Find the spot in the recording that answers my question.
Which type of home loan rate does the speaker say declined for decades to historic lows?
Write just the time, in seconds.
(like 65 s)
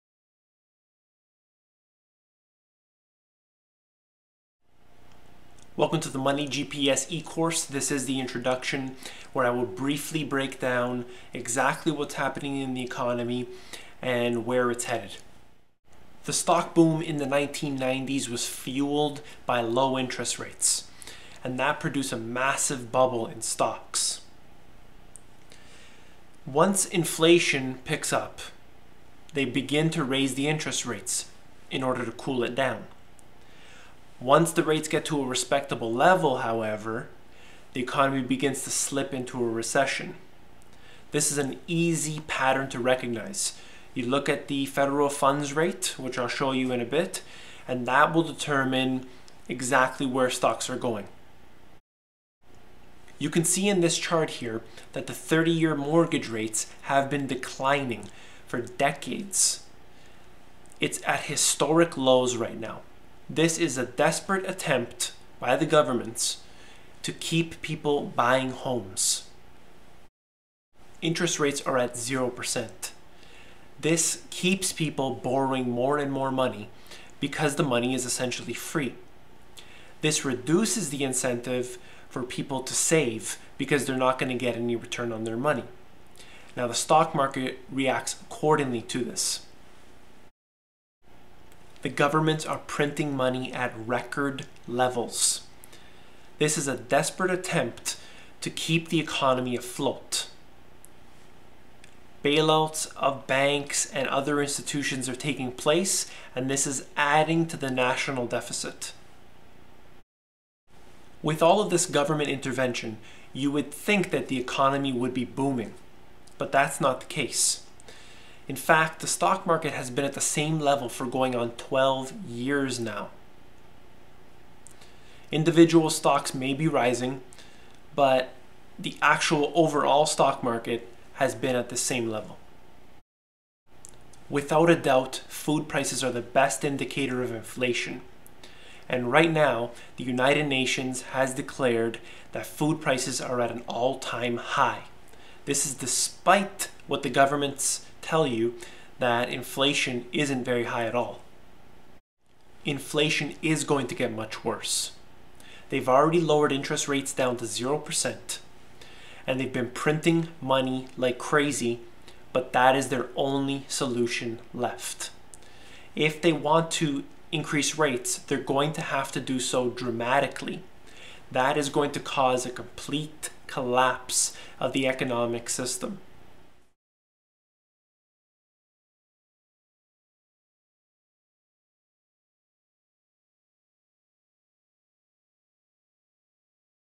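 55 s.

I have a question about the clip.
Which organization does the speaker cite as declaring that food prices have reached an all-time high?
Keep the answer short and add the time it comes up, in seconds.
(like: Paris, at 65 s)
United Nations, at 140 s.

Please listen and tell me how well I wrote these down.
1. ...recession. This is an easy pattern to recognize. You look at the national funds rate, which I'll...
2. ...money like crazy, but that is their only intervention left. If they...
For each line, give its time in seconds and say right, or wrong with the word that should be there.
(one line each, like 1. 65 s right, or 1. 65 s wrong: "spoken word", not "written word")
1. 39 s wrong: "federal", not "national"
2. 160 s wrong: "solution", not "intervention".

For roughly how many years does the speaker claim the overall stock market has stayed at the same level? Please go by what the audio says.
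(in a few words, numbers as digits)
12.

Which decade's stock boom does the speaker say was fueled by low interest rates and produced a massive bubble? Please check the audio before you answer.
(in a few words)
1990s.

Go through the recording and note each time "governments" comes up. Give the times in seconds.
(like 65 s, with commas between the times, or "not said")
65 s, 91 s, 111 s, 147 s.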